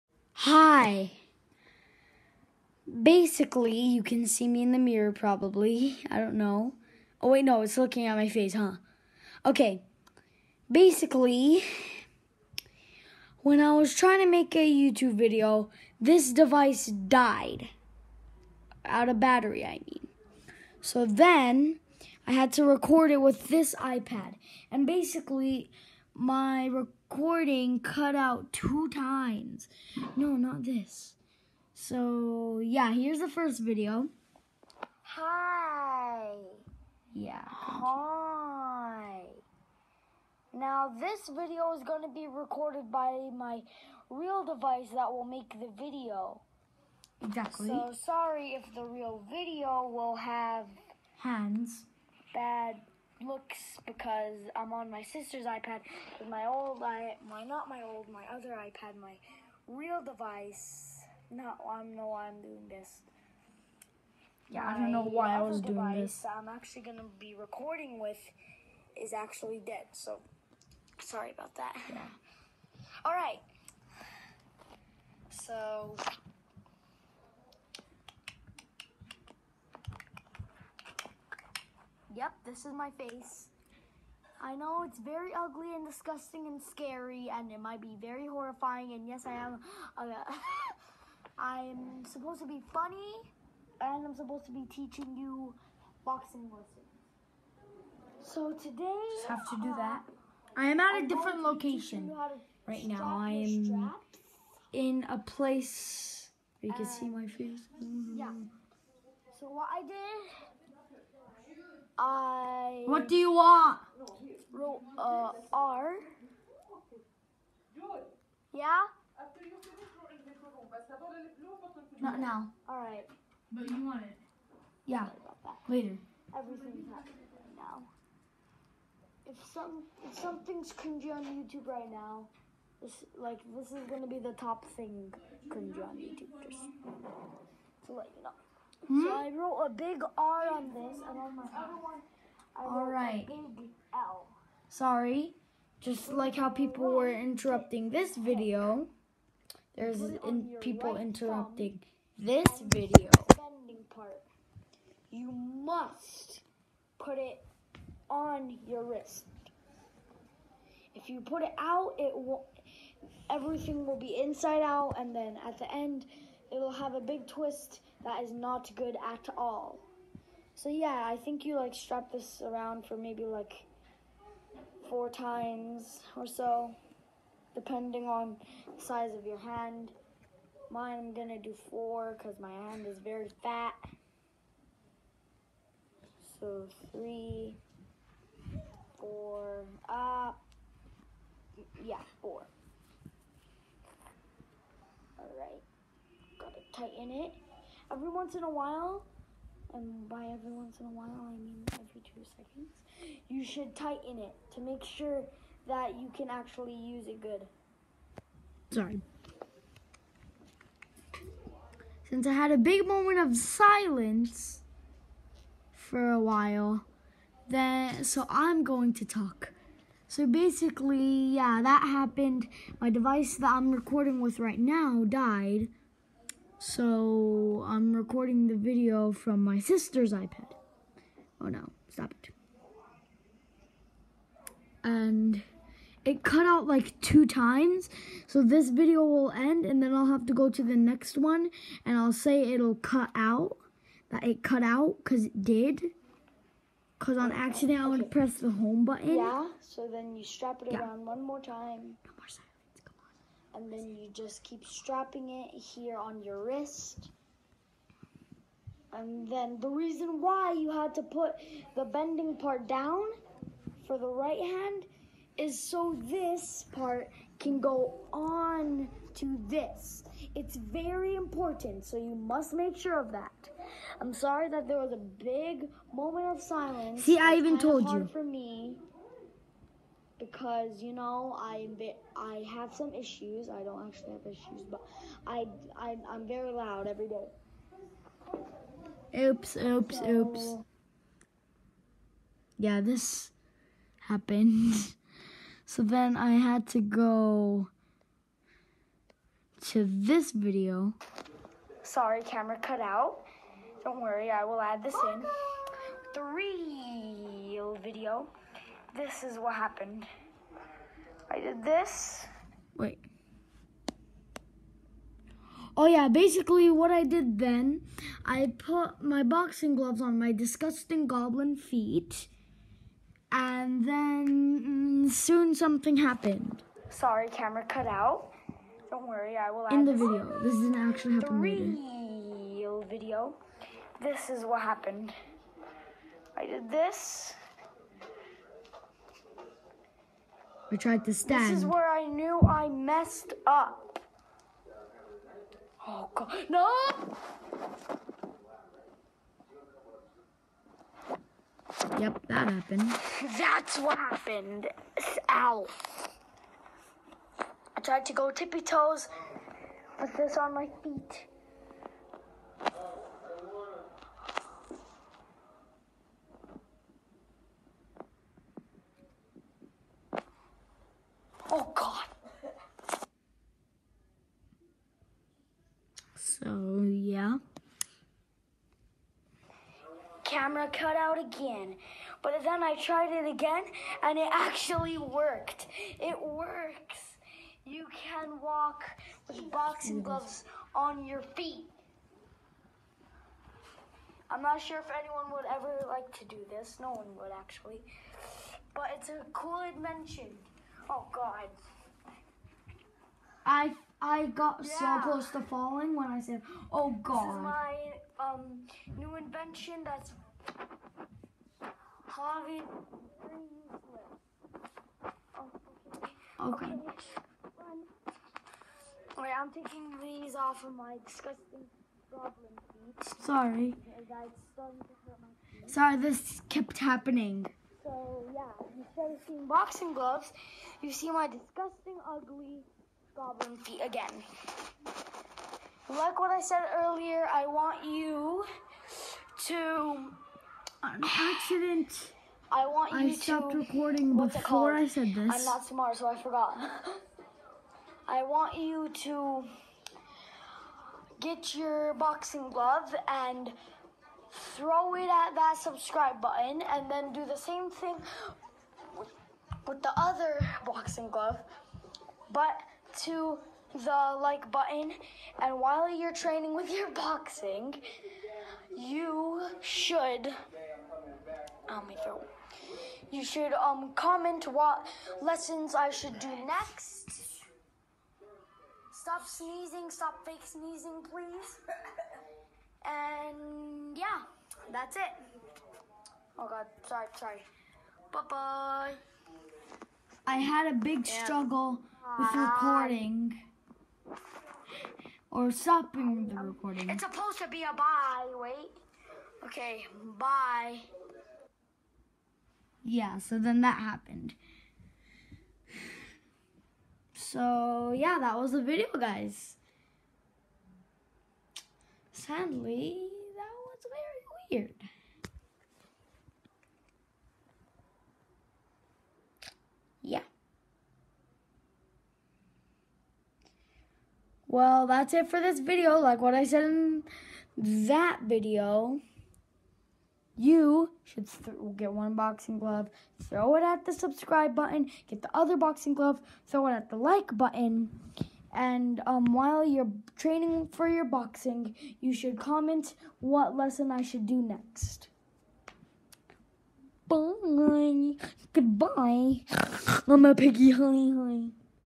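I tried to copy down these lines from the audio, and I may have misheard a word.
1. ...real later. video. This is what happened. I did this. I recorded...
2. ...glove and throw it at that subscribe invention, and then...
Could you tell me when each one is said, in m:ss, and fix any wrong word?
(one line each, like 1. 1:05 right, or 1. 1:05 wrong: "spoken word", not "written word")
1. 5:31 wrong: "tried", not "recorded"
2. 7:32 wrong: "button", not "invention".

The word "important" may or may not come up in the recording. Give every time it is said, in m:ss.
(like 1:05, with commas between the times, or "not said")
4:31.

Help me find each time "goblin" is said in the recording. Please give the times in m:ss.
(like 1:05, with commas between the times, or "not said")
5:21, 7:02, 7:13.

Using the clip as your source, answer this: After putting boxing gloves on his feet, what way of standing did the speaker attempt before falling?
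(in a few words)
Tippy toes.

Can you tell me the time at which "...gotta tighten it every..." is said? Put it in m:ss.
3:16.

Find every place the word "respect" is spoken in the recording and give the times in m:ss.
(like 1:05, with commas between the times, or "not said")
not said.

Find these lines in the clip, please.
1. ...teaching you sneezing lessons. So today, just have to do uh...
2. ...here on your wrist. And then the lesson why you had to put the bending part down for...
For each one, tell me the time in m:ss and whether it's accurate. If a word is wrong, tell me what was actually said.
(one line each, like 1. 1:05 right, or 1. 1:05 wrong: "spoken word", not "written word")
1. 1:34 wrong: "boxing", not "sneezing"
2. 4:15 wrong: "reason", not "lesson".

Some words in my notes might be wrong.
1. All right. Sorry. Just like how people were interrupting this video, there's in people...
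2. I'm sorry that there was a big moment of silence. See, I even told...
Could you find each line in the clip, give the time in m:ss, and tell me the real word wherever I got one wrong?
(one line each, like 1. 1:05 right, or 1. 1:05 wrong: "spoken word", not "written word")
1. 2:22 right
2. 4:34 right.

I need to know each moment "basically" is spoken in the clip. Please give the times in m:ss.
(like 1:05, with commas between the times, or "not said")
0:03, 0:10, 0:24, 3:40, 5:16.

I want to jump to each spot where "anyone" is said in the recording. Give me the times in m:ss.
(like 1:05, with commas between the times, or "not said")
6:34.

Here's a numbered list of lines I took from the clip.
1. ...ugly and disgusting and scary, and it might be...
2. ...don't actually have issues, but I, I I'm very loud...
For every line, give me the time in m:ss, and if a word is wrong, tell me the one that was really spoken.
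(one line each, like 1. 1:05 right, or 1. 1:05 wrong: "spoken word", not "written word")
1. 1:25 right
2. 4:43 right.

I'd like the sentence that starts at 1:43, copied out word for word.
I am in a place you can see my face.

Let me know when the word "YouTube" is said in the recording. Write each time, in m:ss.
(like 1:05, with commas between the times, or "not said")
0:14, 2:11, 2:15.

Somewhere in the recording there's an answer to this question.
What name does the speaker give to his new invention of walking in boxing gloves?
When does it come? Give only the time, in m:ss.
6:52.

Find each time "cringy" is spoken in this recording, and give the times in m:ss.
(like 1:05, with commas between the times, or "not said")
2:10, 2:15.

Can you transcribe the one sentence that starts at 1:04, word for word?
Yeah, my I don't know why I was doing this.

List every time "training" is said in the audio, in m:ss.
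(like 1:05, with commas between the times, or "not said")
7:46, 9:00.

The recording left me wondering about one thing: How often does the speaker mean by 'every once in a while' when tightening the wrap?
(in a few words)
Every two seconds.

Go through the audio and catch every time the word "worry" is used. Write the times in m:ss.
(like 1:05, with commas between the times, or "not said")
5:04, 5:29.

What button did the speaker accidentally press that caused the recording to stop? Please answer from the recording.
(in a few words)
Home button.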